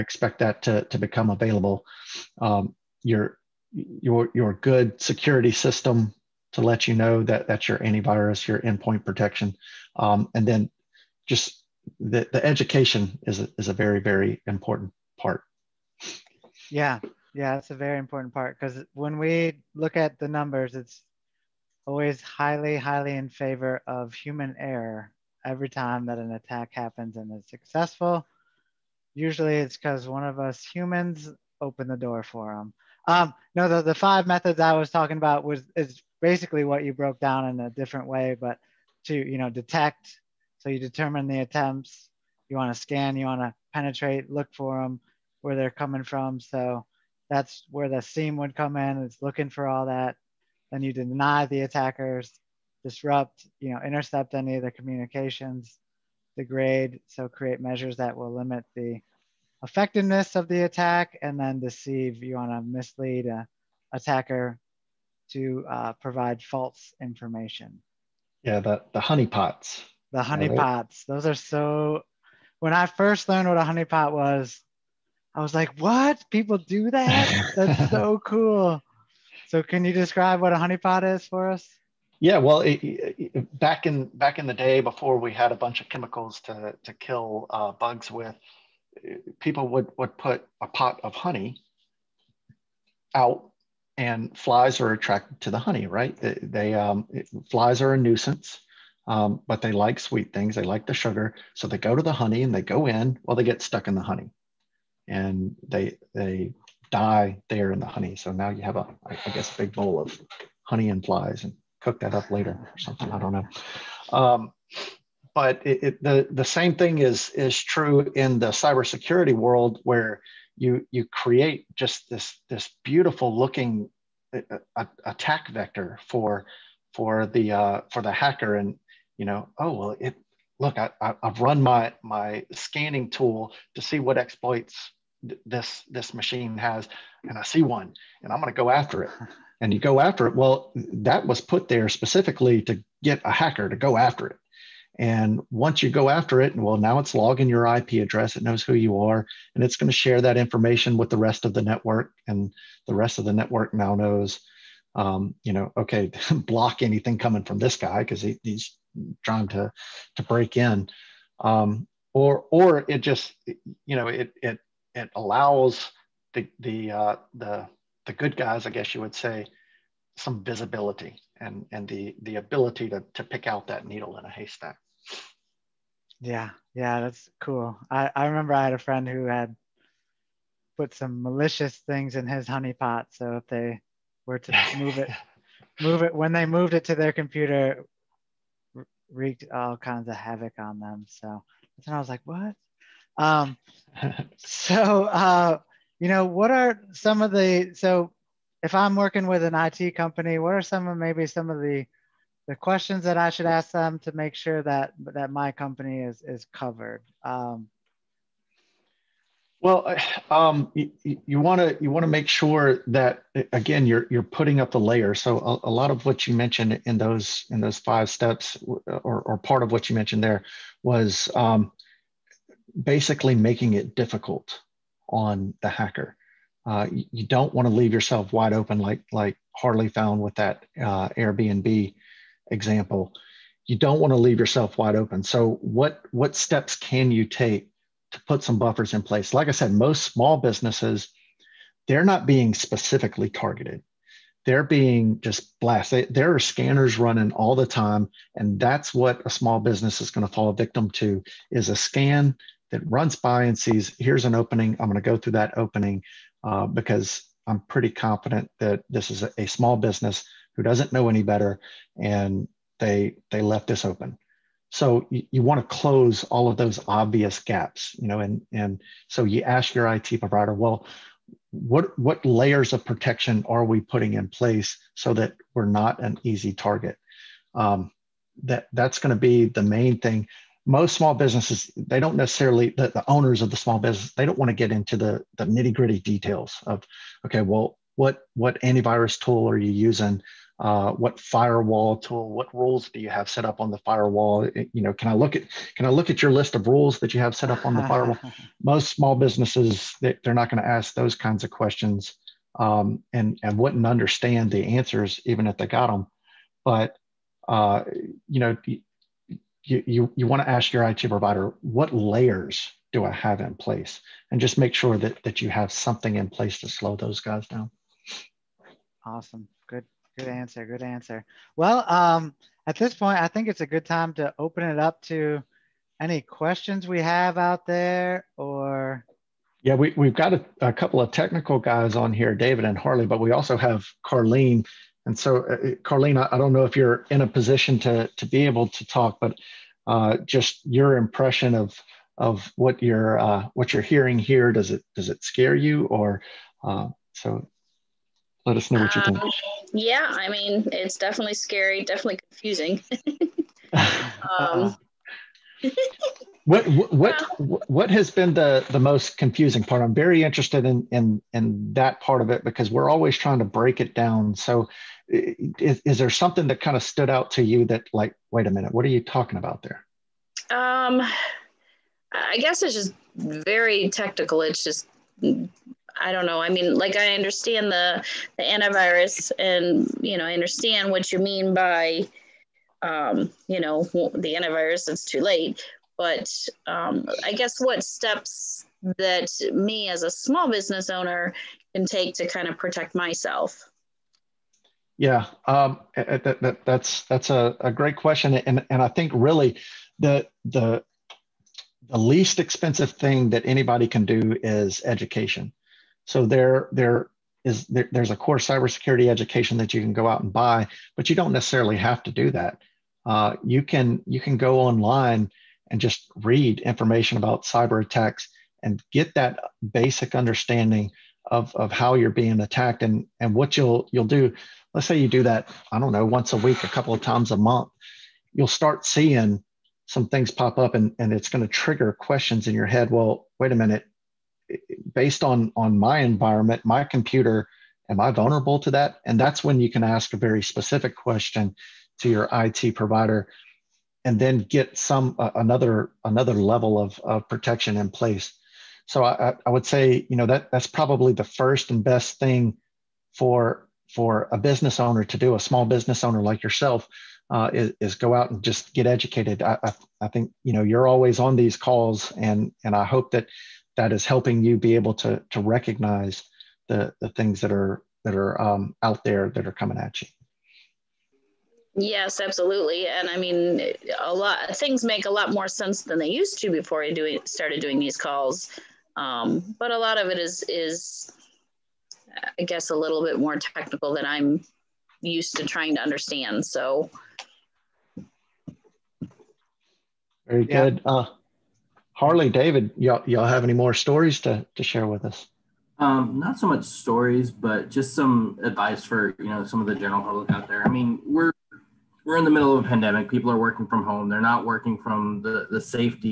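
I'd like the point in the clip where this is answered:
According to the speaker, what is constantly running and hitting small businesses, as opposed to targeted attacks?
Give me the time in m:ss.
4:06.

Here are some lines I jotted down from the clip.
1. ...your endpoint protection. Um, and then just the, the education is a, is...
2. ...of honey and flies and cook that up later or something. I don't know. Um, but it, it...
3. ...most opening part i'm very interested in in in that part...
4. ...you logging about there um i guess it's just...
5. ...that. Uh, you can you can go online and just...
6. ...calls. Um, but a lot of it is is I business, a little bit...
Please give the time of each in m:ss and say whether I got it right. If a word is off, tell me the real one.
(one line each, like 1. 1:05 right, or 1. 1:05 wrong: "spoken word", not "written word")
1. 0:08 right
2. 1:50 right
3. 5:58 wrong: "confusing", not "opening"
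4. 6:08 wrong: "talking", not "logging"
5. 6:52 right
6. 7:57 wrong: "guess", not "business".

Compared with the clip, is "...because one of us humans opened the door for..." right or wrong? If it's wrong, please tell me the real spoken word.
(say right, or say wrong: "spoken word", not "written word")
right.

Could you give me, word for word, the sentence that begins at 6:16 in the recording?
I mean, like I understand the the antivirus, and you know, I understand what you mean by, um, you know, the antivirus.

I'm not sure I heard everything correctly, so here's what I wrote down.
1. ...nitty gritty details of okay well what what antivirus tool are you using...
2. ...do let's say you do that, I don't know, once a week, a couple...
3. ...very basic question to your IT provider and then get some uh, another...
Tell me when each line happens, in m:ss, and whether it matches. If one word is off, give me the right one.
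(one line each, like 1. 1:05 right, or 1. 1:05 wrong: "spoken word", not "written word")
1. 4:45 right
2. 7:04 right
3. 7:20 wrong: "specific", not "basic".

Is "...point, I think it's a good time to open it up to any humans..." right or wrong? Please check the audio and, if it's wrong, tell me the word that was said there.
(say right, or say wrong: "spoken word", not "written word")
wrong: "questions", not "humans".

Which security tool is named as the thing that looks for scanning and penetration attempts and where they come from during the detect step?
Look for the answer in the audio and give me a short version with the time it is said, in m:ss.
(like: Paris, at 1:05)
SIEM, at 0:48.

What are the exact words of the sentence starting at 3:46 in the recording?
Uh, you don't want to leave yourself wide open, like like Harley found with that uh, Airbnb example.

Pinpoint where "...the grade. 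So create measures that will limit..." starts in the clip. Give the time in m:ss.
0:56.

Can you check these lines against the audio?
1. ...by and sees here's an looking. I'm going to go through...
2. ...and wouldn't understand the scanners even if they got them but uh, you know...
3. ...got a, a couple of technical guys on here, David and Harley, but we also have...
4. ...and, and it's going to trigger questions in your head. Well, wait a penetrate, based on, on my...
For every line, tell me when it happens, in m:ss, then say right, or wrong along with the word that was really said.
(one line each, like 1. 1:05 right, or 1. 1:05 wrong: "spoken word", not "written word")
1. 4:13 wrong: "opening", not "looking"
2. 5:03 wrong: "answers", not "scanners"
3. 5:30 right
4. 7:10 wrong: "minute", not "penetrate".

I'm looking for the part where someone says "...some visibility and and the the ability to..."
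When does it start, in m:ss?
2:50.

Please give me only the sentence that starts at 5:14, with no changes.
And just make sure that, that you have something in place to slow those guys down.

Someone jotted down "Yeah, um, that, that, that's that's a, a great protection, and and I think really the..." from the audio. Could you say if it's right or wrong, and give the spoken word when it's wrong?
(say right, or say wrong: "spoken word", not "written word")
wrong: "question", not "protection".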